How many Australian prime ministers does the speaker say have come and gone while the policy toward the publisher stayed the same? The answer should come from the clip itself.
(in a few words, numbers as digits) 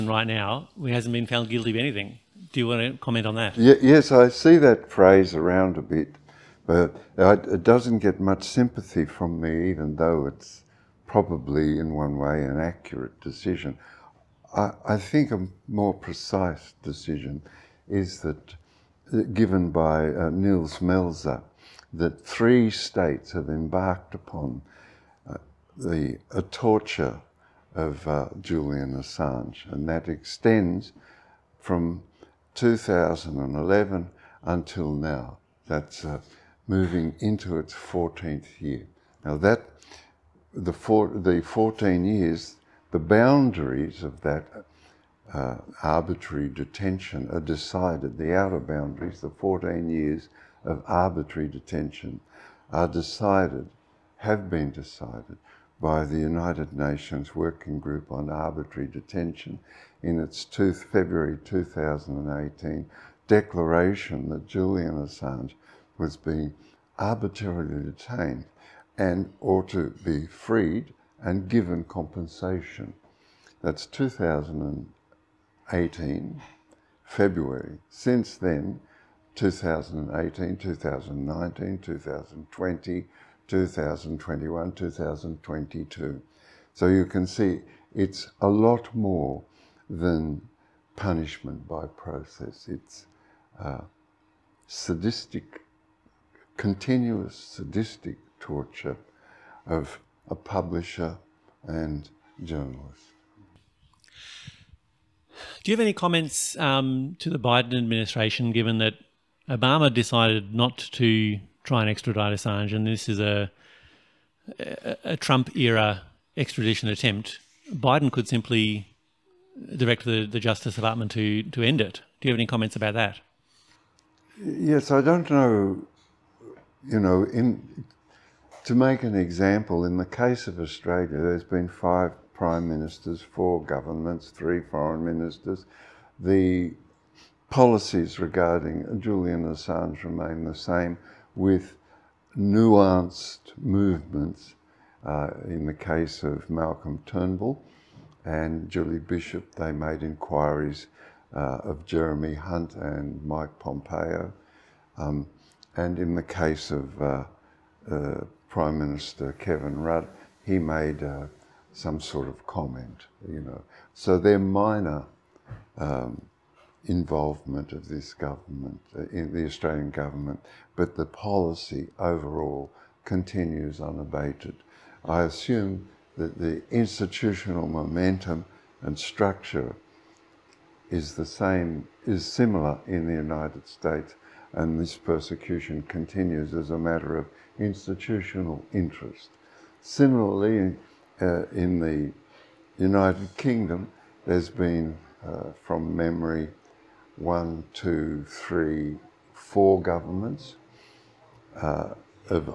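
5.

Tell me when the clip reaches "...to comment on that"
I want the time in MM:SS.
00:02.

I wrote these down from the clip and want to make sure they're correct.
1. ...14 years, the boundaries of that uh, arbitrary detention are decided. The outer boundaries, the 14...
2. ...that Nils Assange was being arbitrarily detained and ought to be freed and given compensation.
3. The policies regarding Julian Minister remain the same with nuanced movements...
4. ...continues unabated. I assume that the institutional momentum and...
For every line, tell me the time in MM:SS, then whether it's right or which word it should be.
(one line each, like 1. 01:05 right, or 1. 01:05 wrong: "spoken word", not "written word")
1. 00:41 right
2. 01:04 wrong: "Julian", not "Nils"
3. 02:16 wrong: "Assange", not "Minister"
4. 02:53 right.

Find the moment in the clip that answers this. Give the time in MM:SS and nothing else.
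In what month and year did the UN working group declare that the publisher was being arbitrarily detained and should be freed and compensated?
01:00.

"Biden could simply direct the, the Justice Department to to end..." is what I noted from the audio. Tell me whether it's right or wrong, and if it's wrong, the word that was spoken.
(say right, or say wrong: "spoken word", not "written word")
right.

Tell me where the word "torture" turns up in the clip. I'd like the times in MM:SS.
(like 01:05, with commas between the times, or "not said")
00:26, 01:38.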